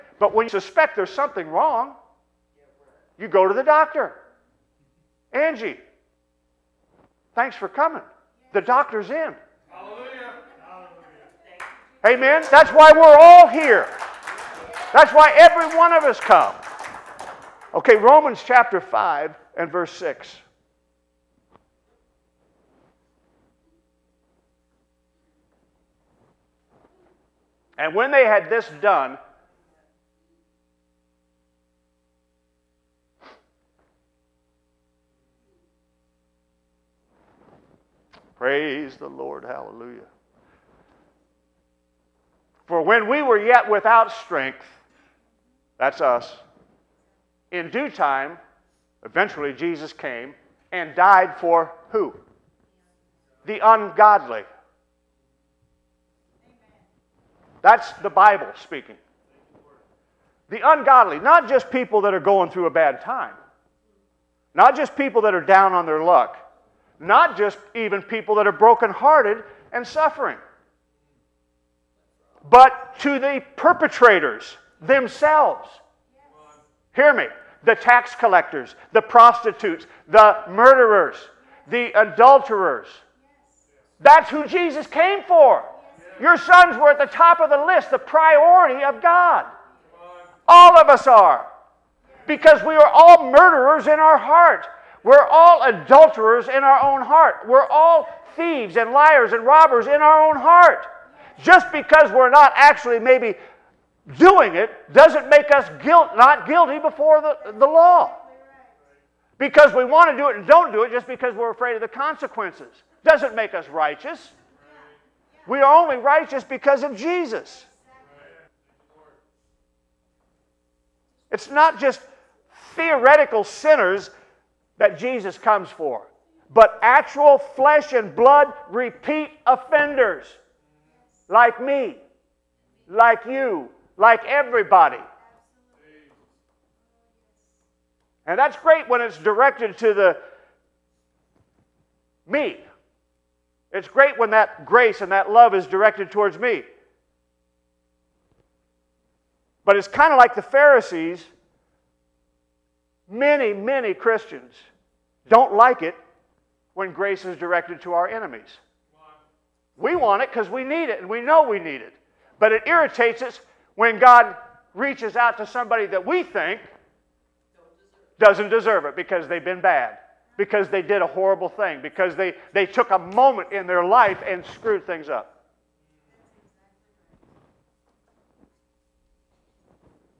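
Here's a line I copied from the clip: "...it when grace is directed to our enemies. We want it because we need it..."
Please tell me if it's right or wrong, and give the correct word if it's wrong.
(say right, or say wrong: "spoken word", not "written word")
right.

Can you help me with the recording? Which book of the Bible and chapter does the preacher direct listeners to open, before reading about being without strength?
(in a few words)
Romans chapter 5.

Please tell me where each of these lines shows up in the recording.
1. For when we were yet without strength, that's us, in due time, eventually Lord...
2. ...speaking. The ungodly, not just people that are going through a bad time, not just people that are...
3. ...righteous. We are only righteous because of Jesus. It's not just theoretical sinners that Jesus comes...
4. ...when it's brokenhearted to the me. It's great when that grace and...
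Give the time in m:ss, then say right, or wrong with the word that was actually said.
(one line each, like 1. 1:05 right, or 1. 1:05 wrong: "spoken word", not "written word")
1. 0:42 wrong: "Jesus", not "Lord"
2. 0:58 right
3. 1:53 right
4. 2:18 wrong: "directed", not "brokenhearted".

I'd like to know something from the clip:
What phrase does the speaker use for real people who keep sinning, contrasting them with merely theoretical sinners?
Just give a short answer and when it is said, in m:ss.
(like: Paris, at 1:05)
Repeat offenders, at 2:08.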